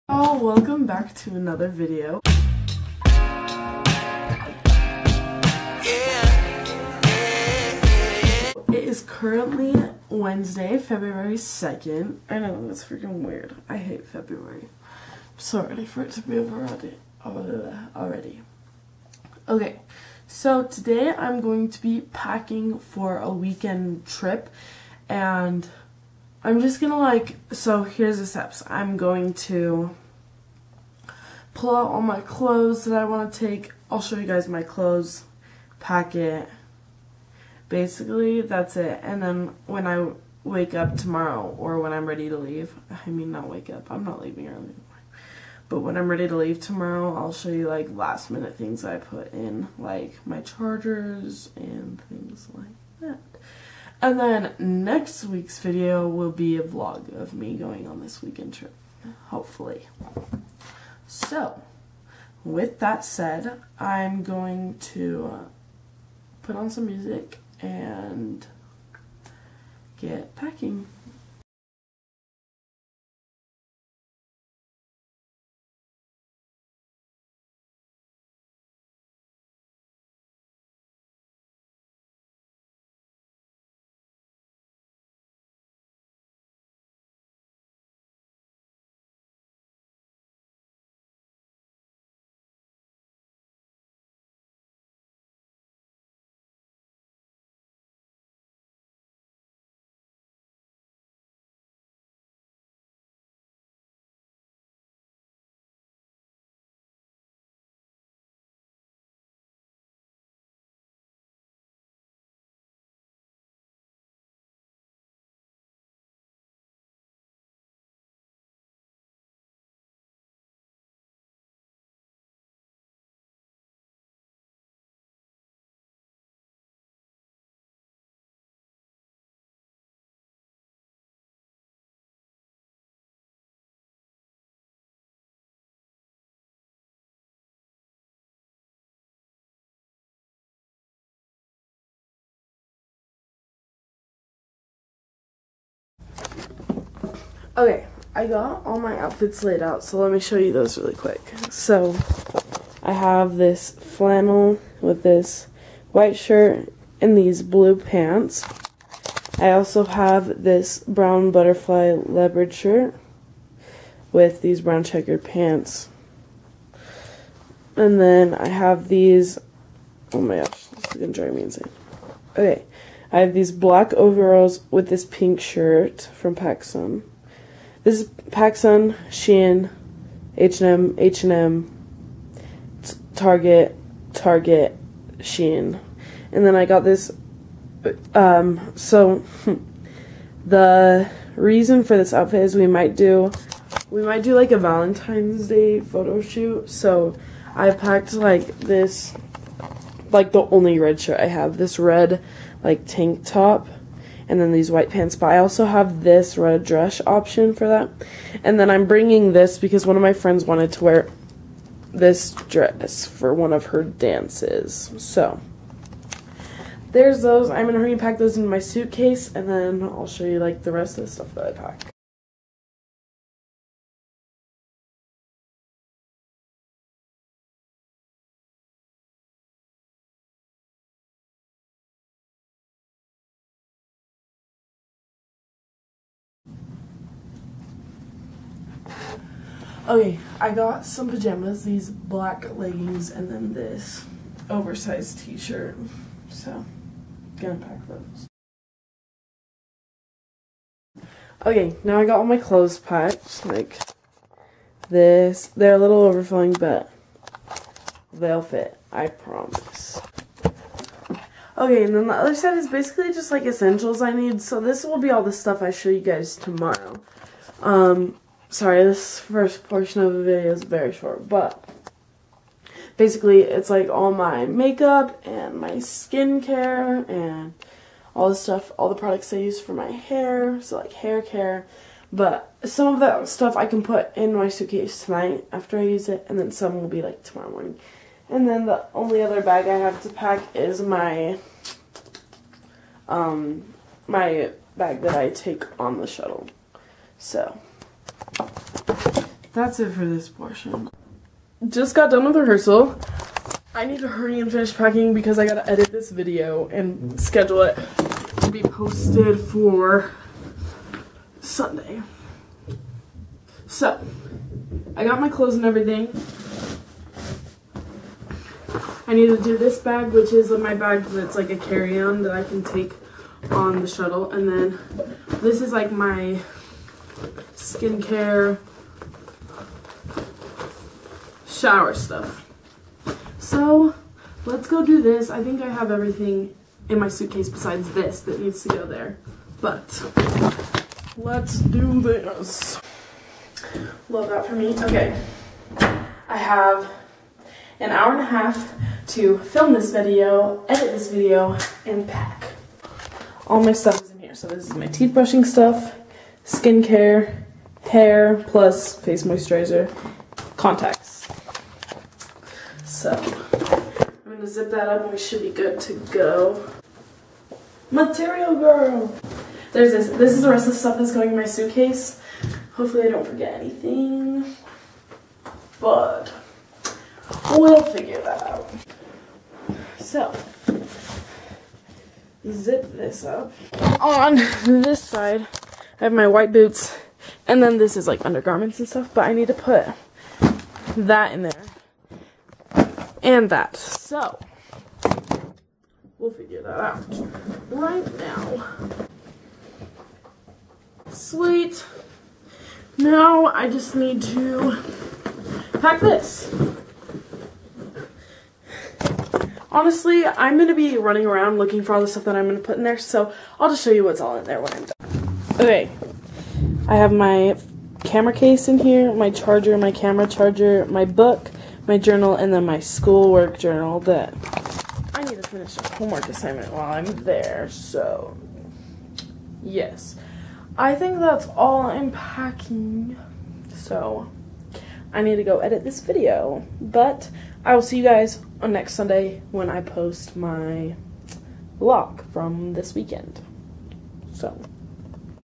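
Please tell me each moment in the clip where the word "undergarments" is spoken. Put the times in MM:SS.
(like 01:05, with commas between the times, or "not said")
06:28.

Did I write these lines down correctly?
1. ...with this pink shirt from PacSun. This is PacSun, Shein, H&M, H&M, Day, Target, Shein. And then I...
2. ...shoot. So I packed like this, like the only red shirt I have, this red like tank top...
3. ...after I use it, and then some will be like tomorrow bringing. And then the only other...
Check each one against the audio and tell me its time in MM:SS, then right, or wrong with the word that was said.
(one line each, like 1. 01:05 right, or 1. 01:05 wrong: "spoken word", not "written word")
1. 02:54 wrong: "Target", not "Day"
2. 03:16 right
3. 04:45 wrong: "morning", not "bringing".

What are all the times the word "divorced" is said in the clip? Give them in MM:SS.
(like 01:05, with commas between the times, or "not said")
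not said.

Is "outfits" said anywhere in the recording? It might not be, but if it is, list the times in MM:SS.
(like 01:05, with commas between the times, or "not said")
02:28, 03:12.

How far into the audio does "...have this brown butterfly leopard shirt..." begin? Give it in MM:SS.
02:39.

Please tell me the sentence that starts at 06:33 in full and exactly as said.
So, we'll figure that out right now.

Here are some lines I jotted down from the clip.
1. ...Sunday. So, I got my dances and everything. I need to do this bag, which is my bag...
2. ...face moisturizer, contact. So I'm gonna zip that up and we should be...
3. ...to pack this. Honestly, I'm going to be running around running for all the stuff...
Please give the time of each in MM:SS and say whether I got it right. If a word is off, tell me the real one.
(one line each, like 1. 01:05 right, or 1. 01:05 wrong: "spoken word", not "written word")
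1. 05:11 wrong: "clothes", not "dances"
2. 05:58 right
3. 06:44 wrong: "looking", not "running".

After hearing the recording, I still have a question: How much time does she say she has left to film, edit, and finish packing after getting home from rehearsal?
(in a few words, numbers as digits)
an hour and a half.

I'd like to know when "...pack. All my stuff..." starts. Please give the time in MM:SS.
05:52.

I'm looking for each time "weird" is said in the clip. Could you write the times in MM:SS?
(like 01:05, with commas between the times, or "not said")
00:13.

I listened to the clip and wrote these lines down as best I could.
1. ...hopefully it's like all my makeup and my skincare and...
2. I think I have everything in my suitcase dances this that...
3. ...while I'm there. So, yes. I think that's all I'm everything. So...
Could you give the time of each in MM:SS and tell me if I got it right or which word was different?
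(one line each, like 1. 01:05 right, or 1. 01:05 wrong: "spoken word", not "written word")
1. 04:32 wrong: "basically", not "hopefully"
2. 05:35 wrong: "besides", not "dances"
3. 07:06 wrong: "packing", not "everything".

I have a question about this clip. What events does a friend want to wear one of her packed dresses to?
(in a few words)
dances.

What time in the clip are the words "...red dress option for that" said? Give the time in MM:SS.
03:26.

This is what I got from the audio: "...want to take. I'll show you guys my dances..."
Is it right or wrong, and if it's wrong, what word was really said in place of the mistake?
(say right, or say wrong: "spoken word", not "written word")
wrong: "clothes", not "dances".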